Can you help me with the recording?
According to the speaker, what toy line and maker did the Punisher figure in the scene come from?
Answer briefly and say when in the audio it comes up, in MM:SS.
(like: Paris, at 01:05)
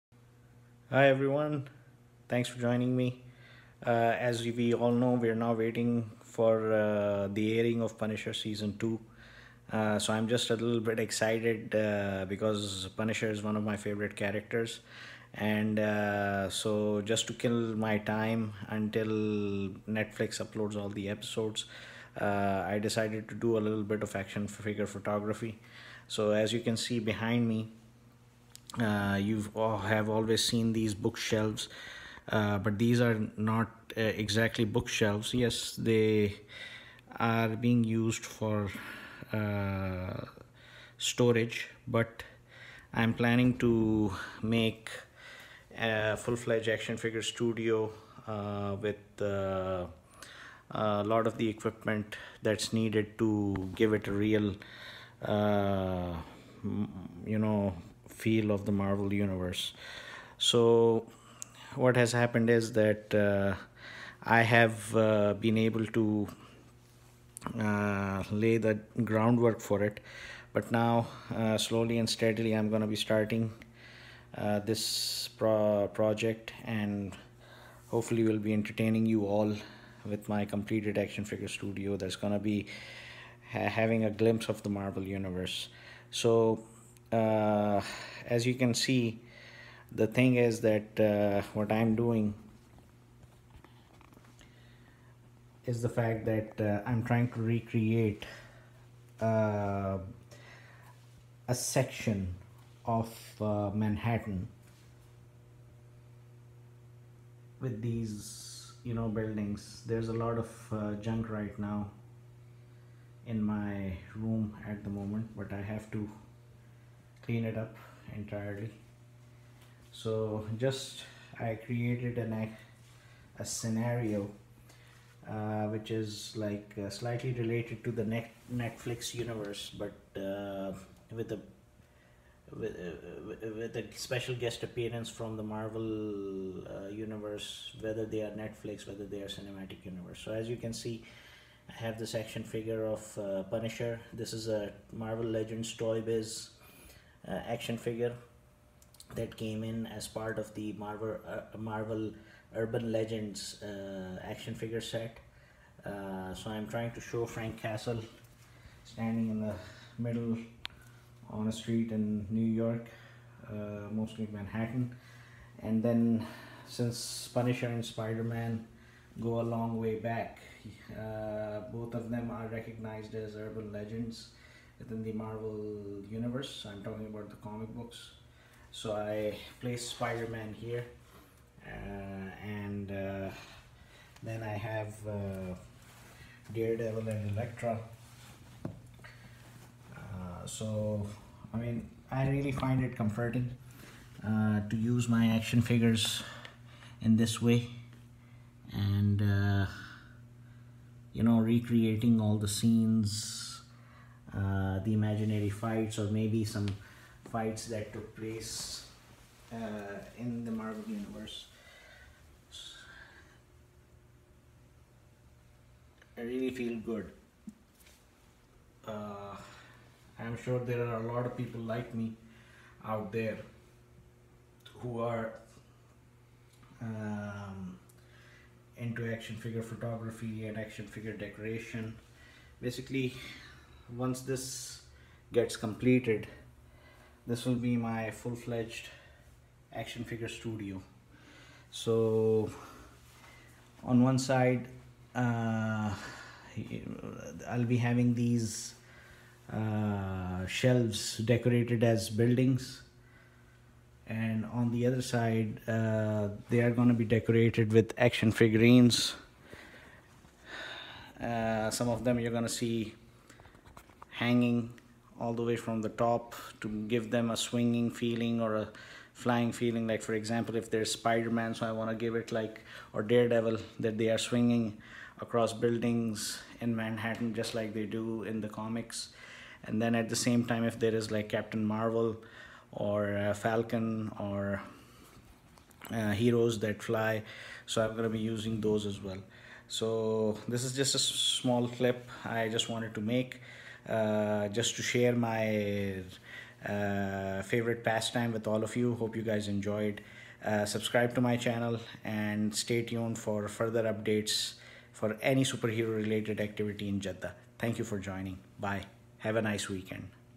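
Marvel Legends Toy Biz, at 02:24.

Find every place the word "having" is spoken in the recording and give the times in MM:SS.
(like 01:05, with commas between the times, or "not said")
01:23, 04:07.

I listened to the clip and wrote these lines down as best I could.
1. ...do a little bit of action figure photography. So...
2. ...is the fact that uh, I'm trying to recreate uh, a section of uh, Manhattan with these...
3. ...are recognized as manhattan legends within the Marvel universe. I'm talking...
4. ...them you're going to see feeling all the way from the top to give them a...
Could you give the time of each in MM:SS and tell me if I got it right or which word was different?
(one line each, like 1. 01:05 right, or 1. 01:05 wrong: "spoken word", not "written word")
1. 00:23 right
2. 01:35 right
3. 02:52 wrong: "urban", not "manhattan"
4. 04:22 wrong: "hanging", not "feeling".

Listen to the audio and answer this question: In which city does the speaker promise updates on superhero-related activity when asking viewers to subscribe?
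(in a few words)
Jeddah.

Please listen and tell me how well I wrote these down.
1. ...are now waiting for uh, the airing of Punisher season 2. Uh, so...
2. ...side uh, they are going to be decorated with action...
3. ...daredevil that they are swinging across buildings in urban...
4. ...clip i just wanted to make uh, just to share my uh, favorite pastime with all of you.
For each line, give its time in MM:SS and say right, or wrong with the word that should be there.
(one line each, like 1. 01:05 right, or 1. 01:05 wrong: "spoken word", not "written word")
1. 00:05 right
2. 04:15 right
3. 04:33 wrong: "manhattan", not "urban"
4. 04:51 right.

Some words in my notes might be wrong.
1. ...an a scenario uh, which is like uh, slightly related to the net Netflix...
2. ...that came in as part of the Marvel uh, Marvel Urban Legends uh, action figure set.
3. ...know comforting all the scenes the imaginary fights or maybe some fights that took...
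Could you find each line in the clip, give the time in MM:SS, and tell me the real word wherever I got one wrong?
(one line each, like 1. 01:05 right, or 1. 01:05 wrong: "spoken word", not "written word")
1. 02:02 right
2. 02:29 right
3. 03:21 wrong: "recreating", not "comforting".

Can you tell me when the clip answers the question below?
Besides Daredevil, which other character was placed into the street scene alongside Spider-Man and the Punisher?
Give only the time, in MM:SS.
03:07.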